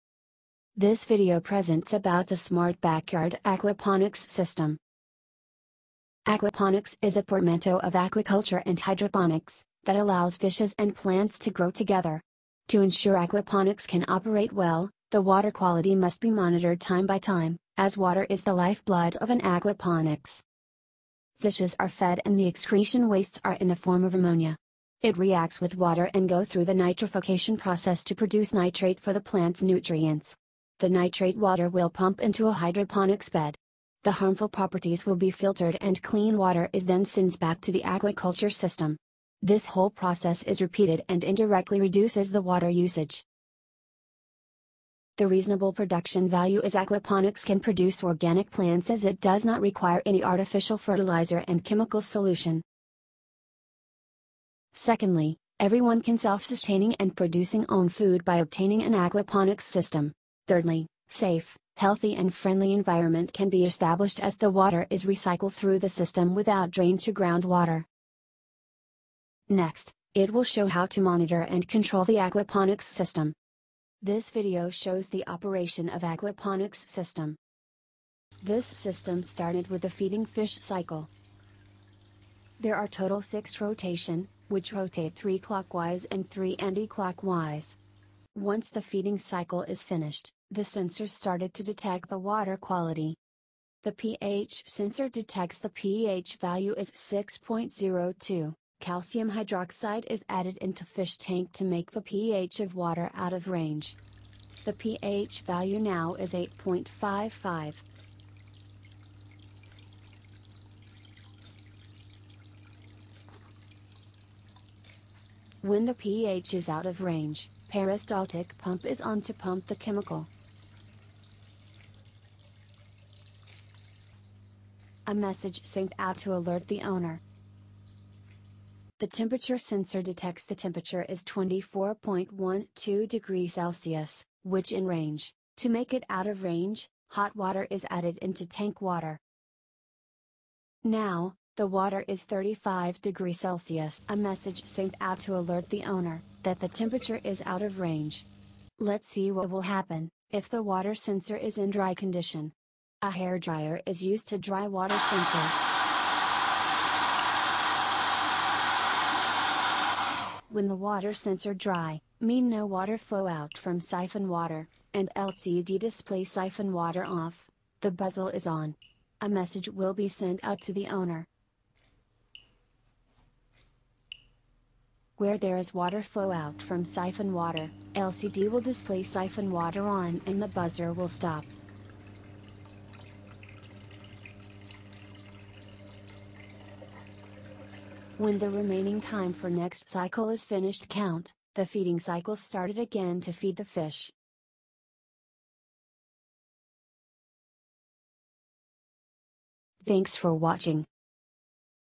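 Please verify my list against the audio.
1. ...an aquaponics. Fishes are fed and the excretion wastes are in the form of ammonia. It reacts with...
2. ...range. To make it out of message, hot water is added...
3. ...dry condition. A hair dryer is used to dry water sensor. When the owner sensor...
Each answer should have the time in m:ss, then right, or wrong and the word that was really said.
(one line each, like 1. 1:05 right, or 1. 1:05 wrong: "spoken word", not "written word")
1. 0:19 right
2. 2:14 wrong: "range", not "message"
3. 2:31 wrong: "water", not "owner".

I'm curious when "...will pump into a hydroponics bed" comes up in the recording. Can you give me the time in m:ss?
0:31.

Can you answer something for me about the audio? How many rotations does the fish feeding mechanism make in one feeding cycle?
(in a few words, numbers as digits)
6.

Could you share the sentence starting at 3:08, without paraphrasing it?
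When the remaining time for next cycle is finished count, the feeding cycle started again to feed the fish.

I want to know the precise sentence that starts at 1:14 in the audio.
This video shows the operation of aquaponics system.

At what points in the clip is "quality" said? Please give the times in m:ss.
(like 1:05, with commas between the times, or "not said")
0:15, 1:32.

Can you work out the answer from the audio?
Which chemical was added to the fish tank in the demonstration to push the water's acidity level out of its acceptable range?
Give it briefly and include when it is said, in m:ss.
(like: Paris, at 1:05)
Calcium hydroxide, at 1:38.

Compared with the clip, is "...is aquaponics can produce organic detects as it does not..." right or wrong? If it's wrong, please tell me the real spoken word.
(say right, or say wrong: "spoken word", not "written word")
wrong: "plants", not "detects".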